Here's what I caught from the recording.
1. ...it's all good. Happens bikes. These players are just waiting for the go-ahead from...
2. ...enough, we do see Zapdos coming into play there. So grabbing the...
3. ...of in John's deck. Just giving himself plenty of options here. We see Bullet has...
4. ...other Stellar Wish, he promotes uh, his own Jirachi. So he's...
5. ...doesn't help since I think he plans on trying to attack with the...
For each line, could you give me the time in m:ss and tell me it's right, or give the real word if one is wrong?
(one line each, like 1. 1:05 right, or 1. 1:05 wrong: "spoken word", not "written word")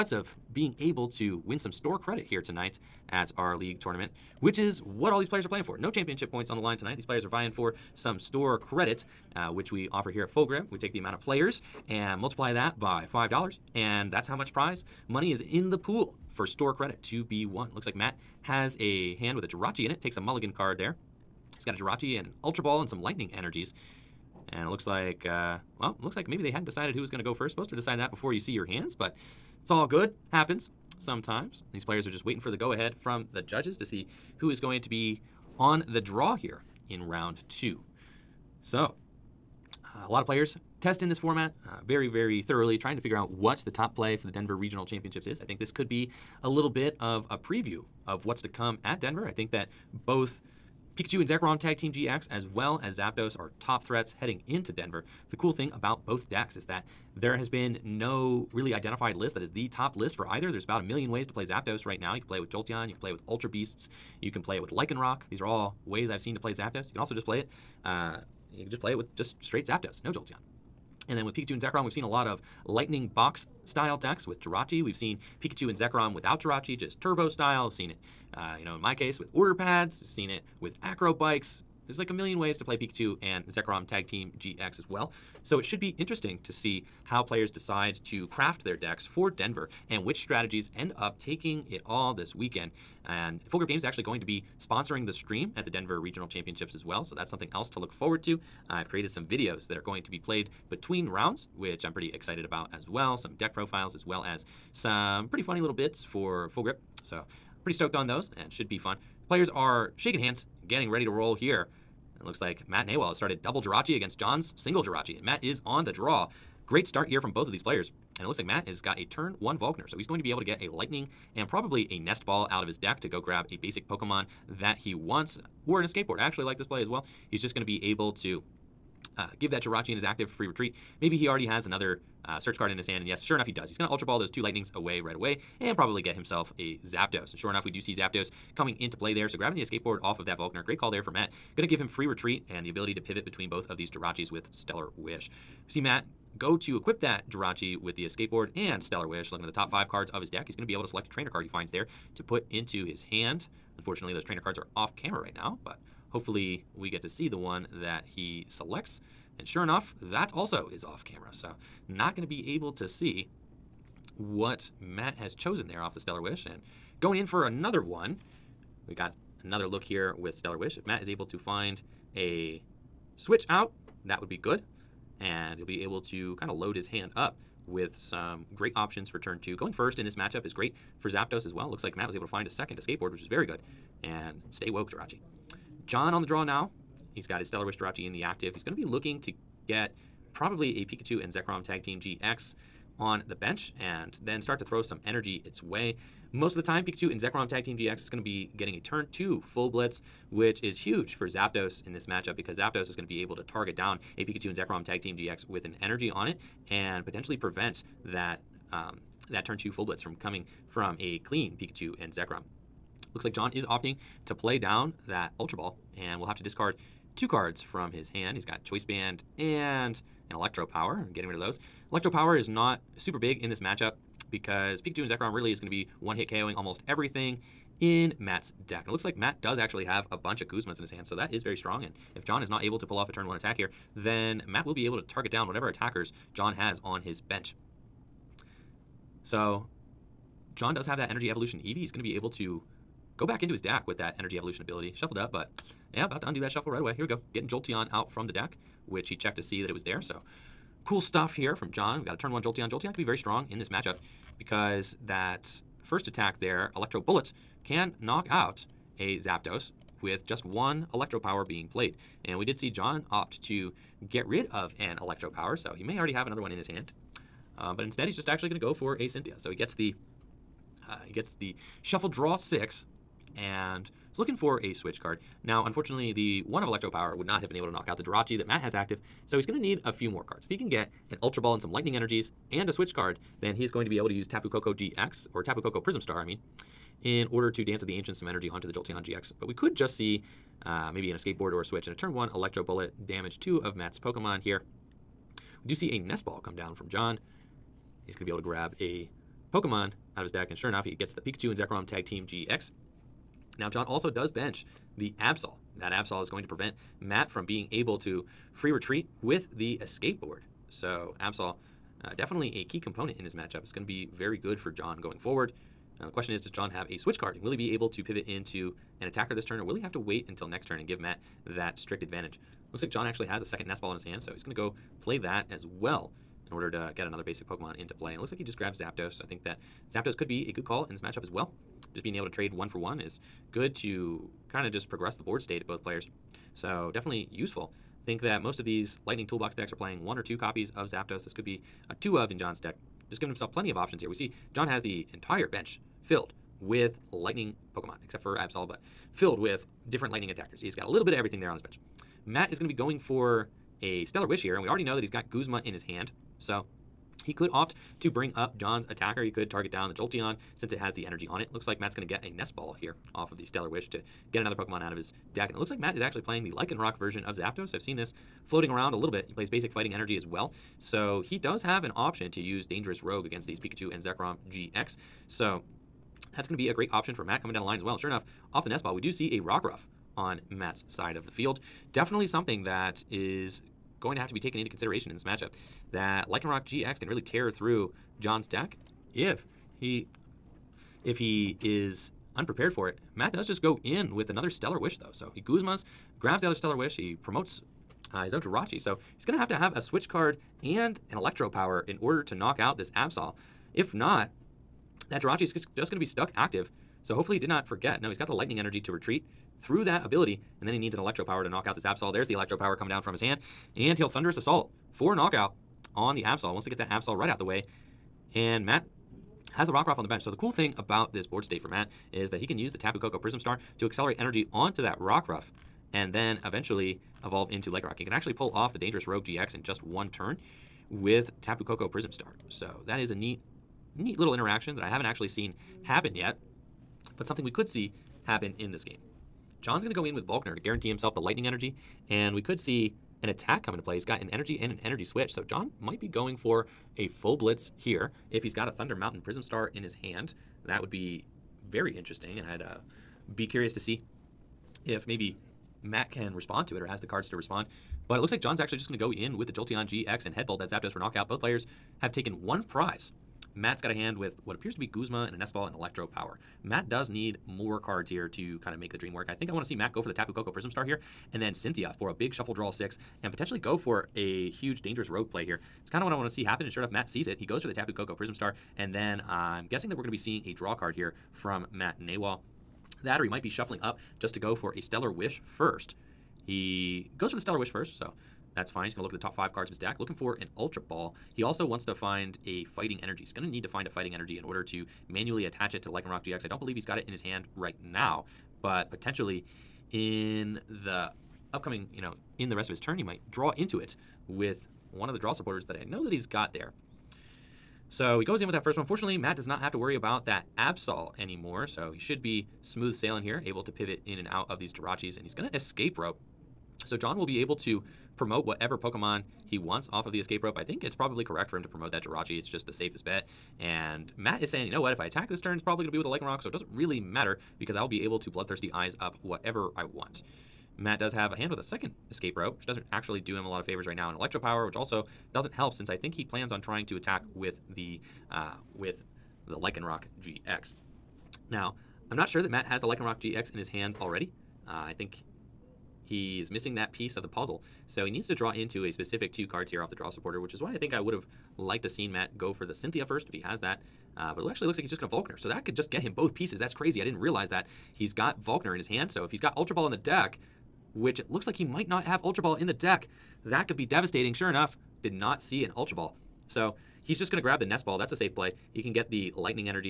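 1. 0:29 wrong: "sometimes", not "bikes"
2. 2:17 right
3. 5:42 wrong: "John", not "Bullet"
4. 6:36 right
5. 8:55 right.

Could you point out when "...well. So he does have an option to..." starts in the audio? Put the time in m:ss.
6:10.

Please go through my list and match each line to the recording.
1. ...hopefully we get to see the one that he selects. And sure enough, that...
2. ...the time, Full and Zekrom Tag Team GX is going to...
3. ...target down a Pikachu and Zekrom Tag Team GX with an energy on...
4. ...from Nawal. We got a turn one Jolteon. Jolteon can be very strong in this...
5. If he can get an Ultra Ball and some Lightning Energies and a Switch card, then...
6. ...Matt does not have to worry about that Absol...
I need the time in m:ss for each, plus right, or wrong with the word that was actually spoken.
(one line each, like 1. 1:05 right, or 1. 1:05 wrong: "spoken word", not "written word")
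1. 2:36 right
2. 3:16 wrong: "Pikachu", not "Full"
3. 3:23 right
4. 4:11 wrong: "John", not "Nawal"
5. 4:40 right
6. 8:29 right.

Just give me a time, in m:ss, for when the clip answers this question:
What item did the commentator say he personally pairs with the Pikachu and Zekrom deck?
1:19.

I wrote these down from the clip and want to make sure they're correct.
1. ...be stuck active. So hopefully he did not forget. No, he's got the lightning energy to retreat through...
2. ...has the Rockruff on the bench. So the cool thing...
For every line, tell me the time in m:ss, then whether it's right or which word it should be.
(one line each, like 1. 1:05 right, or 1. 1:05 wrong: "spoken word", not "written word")
1. 6:45 right
2. 6:59 right.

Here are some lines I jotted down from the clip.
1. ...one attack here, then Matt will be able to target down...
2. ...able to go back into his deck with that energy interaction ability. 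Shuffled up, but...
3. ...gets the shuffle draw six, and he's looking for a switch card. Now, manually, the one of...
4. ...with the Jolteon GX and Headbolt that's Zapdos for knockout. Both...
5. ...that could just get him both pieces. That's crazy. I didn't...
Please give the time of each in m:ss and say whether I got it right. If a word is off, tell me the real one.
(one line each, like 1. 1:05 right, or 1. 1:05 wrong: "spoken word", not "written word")
1. 3:53 right
2. 4:02 wrong: "evolution", not "interaction"
3. 4:31 wrong: "unfortunately", not "manually"
4. 7:39 right
5. 9:15 right.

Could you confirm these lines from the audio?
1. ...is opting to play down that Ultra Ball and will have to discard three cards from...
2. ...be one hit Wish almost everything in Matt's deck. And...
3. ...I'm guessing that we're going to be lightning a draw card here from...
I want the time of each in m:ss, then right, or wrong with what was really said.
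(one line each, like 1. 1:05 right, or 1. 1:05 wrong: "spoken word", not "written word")
1. 3:33 wrong: "two", not "three"
2. 3:45 wrong: "KOing", not "Wish"
3. 7:59 wrong: "seeing", not "lightning".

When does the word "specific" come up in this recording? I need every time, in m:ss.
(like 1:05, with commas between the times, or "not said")
9:08.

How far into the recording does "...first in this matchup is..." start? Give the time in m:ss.
2:59.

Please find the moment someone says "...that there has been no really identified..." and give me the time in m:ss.
0:56.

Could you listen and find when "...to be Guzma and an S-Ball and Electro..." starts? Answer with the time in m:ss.
7:44.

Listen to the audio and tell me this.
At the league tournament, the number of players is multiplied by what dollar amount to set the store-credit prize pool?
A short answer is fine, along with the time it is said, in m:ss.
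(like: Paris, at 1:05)
$5, at 0:13.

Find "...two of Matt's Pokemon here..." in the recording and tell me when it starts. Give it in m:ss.
4:53.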